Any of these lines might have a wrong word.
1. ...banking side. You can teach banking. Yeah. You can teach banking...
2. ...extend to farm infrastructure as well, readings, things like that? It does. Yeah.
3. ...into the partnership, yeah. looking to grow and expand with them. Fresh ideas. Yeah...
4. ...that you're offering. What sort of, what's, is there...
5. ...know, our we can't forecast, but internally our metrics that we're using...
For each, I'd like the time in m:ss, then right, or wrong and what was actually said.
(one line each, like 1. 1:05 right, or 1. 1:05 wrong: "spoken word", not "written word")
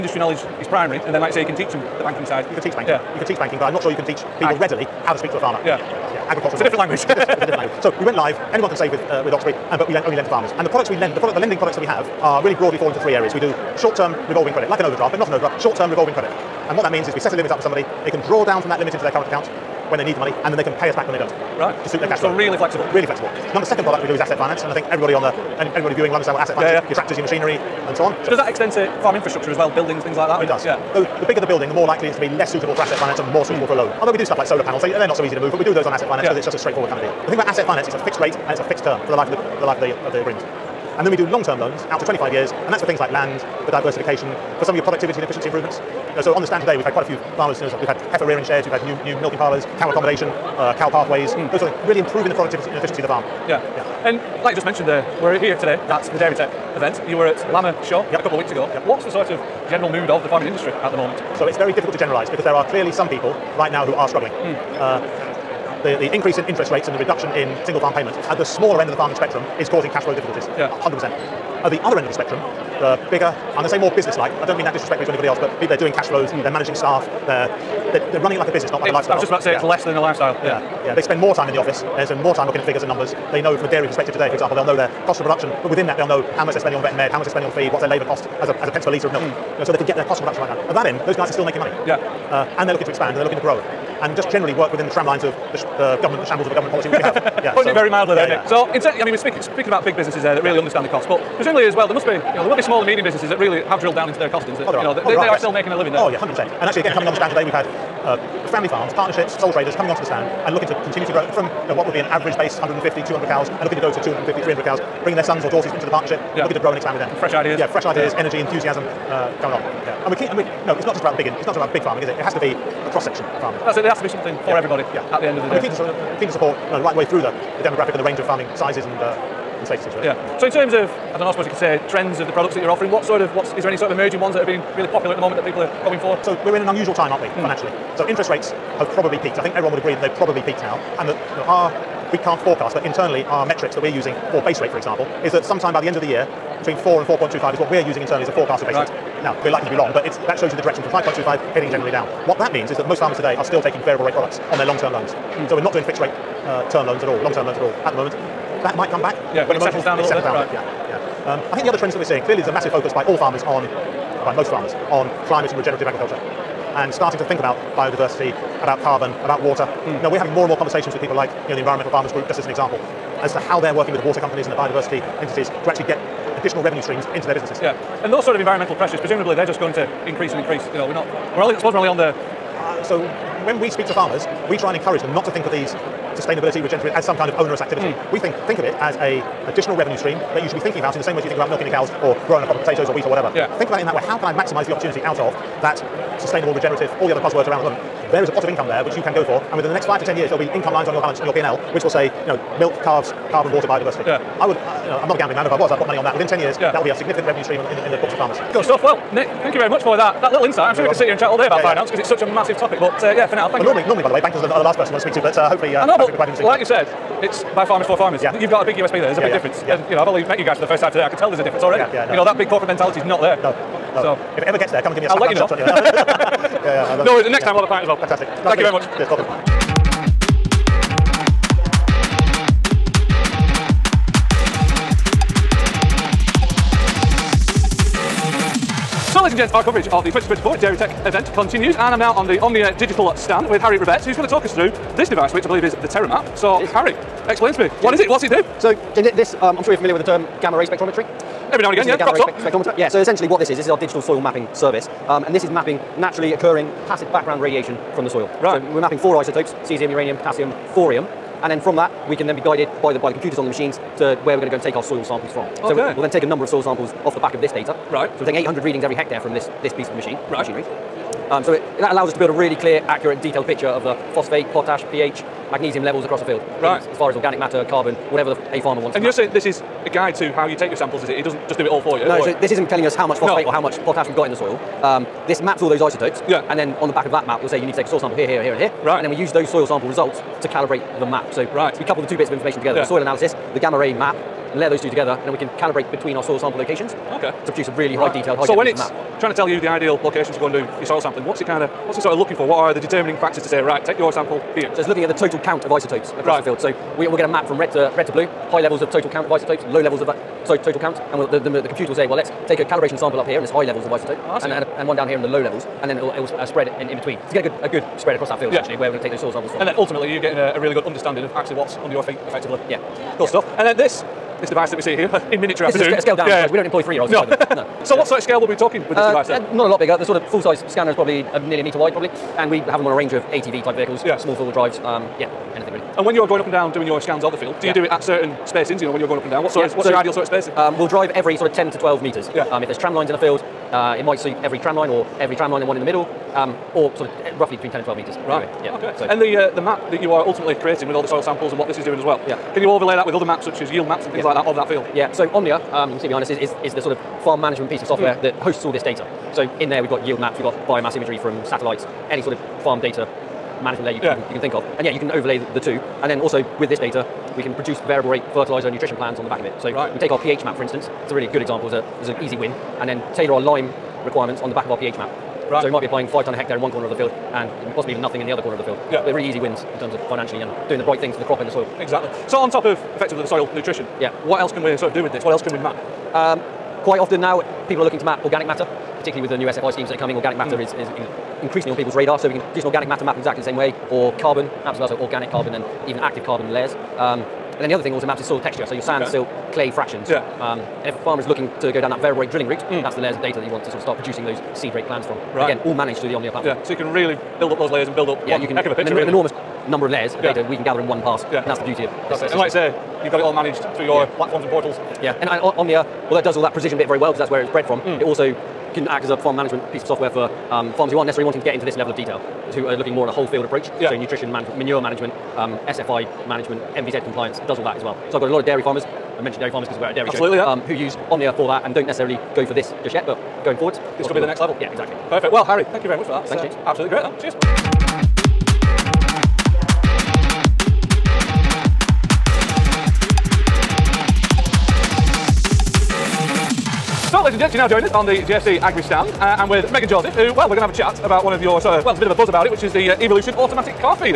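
1. 0:02 right
2. 0:28 wrong: "buildings", not "readings"
3. 1:55 right
4. 2:12 right
5. 2:21 right.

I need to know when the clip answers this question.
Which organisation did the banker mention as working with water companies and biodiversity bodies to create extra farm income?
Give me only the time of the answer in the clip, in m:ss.
2:51.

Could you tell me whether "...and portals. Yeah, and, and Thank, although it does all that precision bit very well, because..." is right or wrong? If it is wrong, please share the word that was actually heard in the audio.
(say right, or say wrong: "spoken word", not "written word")
wrong: "Omnia", not "Thank".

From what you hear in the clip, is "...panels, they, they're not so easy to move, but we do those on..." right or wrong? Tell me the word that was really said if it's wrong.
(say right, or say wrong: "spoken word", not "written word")
right.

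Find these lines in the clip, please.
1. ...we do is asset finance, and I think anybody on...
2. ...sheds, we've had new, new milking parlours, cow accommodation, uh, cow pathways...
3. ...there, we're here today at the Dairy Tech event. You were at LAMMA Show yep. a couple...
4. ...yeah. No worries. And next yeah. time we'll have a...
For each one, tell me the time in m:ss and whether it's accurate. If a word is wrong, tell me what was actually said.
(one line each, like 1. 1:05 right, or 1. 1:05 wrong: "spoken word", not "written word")
1. 0:24 wrong: "everybody", not "anybody"
2. 0:48 right
3. 0:54 right
4. 3:46 right.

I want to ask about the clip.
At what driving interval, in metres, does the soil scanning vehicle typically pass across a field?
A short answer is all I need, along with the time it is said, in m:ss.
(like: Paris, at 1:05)
10 to 12 metres, at 5:41.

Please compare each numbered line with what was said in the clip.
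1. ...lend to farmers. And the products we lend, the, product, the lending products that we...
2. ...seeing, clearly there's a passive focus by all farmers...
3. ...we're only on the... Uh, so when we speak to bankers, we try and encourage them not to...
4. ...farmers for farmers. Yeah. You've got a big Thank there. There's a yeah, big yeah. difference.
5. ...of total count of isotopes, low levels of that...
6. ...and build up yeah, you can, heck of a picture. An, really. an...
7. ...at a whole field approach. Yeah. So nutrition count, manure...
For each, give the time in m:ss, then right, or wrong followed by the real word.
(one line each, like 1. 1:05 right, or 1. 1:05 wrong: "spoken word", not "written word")
1. 0:10 right
2. 2:42 wrong: "massive", not "passive"
3. 3:01 wrong: "farmers", not "bankers"
4. 3:37 wrong: "USP", not "Thank"
5. 5:08 right
6. 6:47 right
7. 7:03 wrong: "management", not "count".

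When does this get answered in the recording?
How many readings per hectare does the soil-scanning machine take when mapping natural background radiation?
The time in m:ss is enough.
4:28.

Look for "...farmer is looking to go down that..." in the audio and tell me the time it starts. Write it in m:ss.
6:41.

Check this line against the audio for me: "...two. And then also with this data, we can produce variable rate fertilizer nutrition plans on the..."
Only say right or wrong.
right.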